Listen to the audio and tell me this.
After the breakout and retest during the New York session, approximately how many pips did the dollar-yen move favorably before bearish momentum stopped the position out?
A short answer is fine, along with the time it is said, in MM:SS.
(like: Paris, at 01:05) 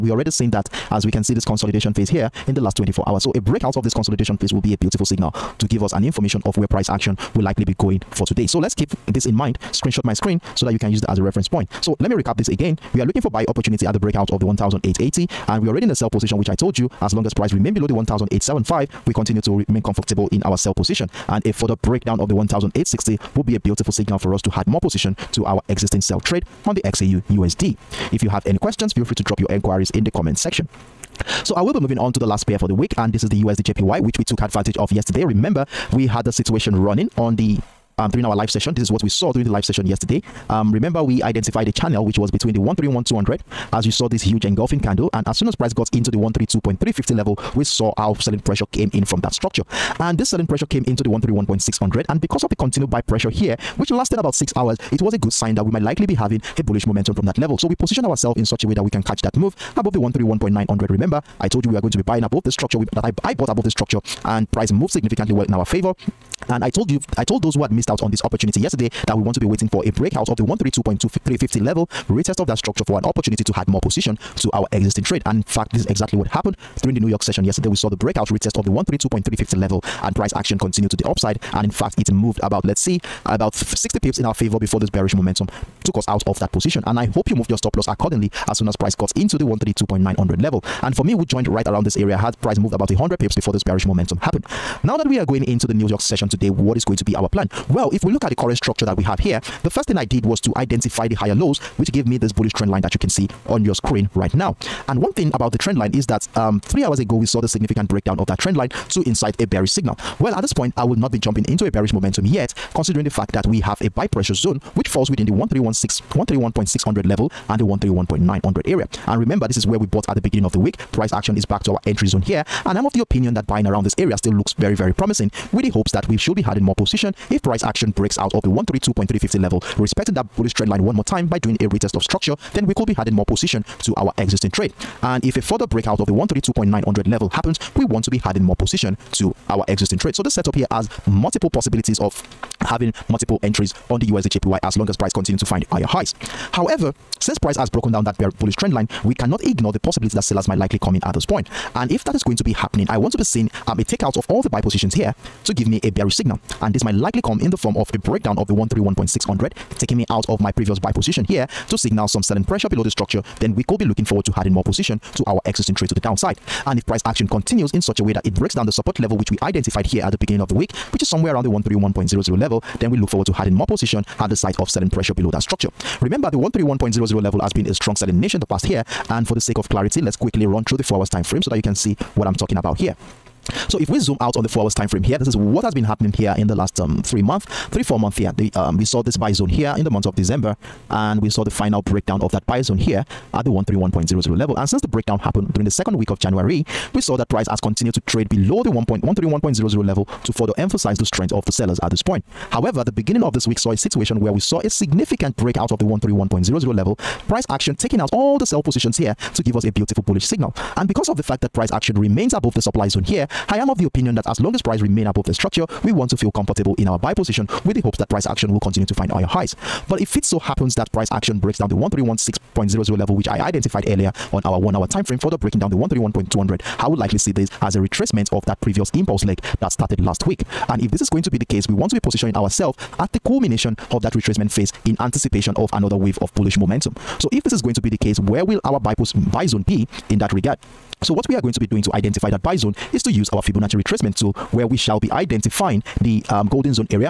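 60 pips, at 01:23.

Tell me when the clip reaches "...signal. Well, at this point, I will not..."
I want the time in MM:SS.
01:49.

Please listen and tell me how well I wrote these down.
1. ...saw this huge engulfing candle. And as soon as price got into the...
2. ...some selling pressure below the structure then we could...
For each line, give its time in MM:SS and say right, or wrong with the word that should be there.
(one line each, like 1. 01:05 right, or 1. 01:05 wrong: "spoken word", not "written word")
1. 00:43 right
2. 02:42 right.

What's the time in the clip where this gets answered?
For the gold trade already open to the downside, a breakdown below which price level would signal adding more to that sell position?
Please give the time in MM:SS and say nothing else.
00:22.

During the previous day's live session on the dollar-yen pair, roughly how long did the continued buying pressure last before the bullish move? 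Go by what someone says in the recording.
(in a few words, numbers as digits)
six hours.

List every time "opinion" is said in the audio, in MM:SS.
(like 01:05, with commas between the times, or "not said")
02:02, 03:33.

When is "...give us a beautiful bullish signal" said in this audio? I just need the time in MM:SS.
03:29.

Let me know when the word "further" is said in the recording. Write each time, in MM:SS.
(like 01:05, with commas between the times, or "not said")
00:21, 02:15, 03:20, 03:45.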